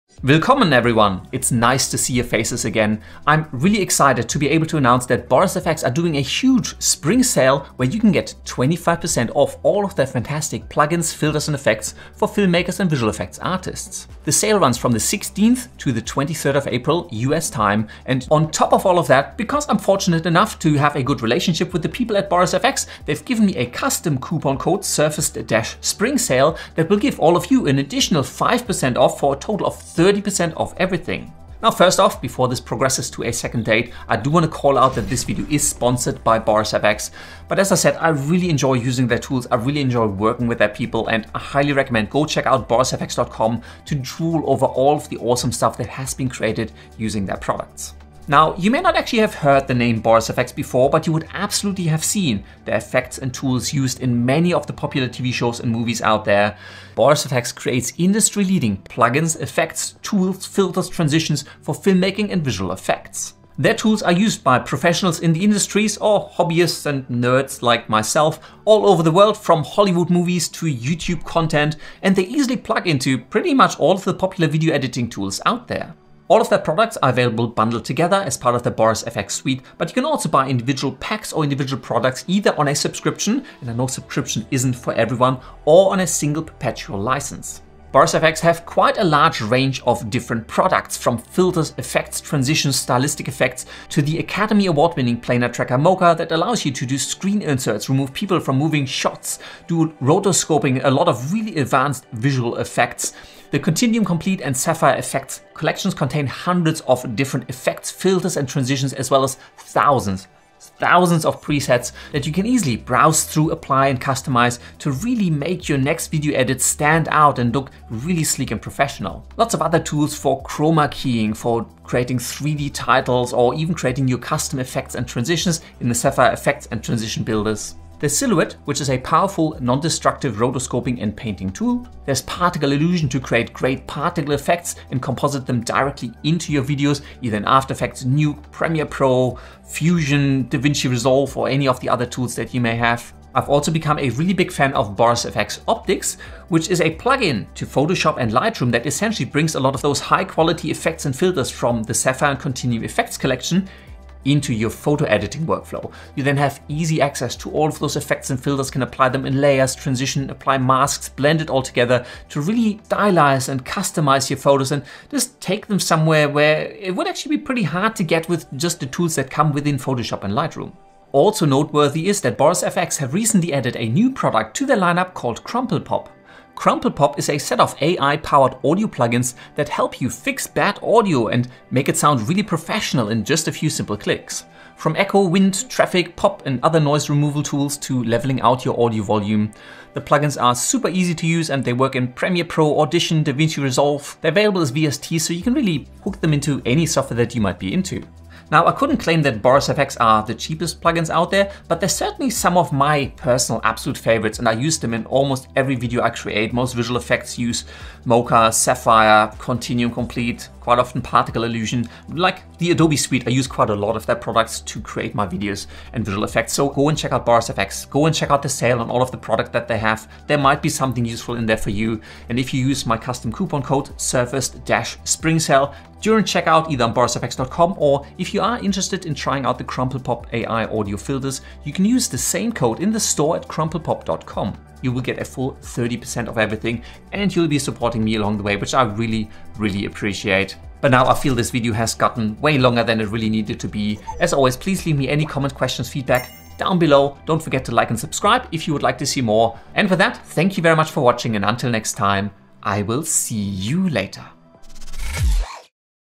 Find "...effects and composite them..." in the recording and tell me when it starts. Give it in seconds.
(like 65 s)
134 s.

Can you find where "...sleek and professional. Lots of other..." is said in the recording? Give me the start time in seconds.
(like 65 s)
118 s.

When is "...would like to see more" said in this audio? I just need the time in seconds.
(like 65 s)
248 s.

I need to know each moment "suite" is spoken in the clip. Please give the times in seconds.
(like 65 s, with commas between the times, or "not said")
79 s, 212 s.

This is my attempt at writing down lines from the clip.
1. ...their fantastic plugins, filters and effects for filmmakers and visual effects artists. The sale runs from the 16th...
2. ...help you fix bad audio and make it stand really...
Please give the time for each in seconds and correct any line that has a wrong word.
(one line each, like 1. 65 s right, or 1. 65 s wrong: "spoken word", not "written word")
1. 9 s right
2. 179 s wrong: "sound", not "stand".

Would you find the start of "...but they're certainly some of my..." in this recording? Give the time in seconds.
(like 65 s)
201 s.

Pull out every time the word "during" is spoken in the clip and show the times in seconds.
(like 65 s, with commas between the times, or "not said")
226 s.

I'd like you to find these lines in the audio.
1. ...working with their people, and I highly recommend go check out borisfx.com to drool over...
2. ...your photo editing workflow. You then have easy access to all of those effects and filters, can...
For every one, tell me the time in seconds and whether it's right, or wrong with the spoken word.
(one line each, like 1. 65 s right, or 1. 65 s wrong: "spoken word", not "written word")
1. 40 s right
2. 154 s right.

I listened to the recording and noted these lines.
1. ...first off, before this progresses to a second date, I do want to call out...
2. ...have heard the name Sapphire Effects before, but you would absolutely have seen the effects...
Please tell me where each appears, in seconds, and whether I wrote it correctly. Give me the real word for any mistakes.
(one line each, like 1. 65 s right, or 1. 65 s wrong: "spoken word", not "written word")
1. 31 s right
2. 49 s wrong: "Boris", not "Sapphire".